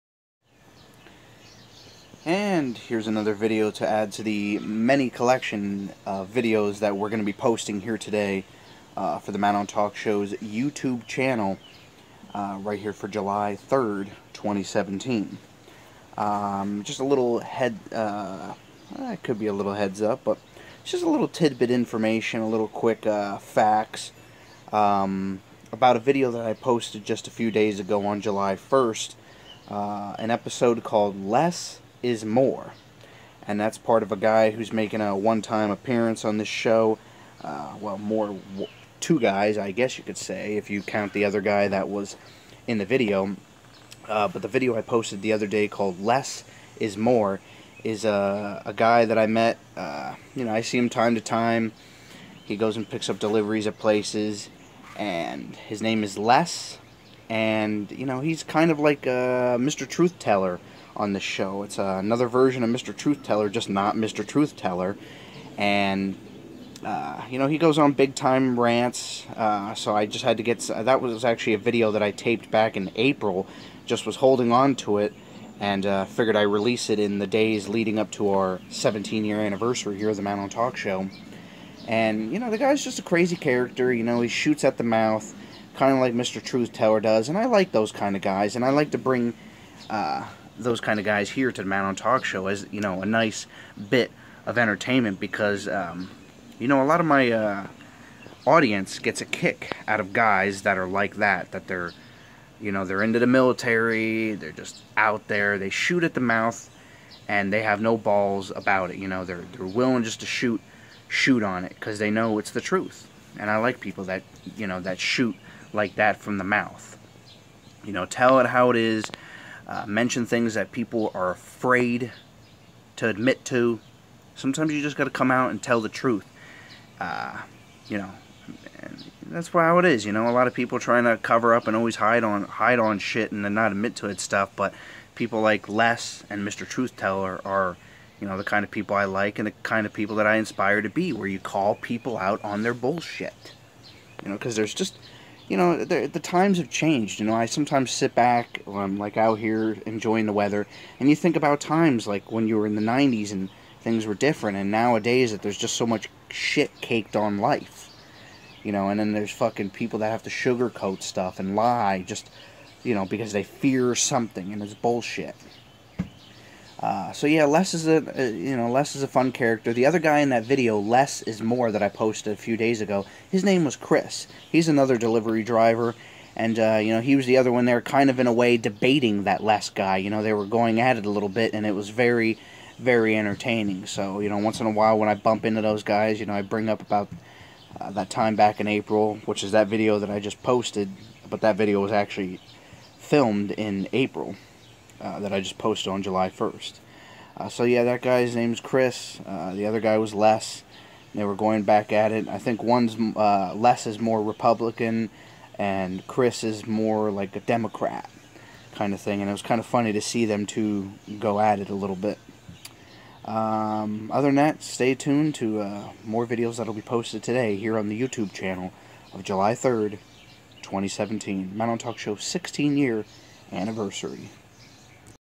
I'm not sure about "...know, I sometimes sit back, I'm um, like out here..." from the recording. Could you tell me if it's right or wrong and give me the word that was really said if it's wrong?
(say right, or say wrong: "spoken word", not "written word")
right.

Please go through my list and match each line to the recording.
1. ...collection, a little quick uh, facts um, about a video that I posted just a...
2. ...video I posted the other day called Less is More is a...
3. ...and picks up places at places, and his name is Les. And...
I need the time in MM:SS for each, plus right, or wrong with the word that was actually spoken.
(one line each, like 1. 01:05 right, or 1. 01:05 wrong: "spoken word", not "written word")
1. 00:21 wrong: "information", not "collection"
2. 00:44 right
3. 00:52 wrong: "deliveries", not "places".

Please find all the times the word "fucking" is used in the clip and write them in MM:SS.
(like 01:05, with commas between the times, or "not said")
02:39.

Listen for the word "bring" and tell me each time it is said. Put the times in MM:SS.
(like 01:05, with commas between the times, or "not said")
01:28, 03:06.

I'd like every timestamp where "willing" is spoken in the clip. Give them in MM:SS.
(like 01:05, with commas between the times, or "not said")
01:49.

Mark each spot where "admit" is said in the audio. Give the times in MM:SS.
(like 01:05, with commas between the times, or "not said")
02:03, 02:13.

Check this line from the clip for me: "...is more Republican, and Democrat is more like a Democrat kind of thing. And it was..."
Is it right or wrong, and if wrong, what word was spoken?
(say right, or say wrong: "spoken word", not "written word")
wrong: "Chris", not "Democrat".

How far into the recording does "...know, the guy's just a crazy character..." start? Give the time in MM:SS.
01:22.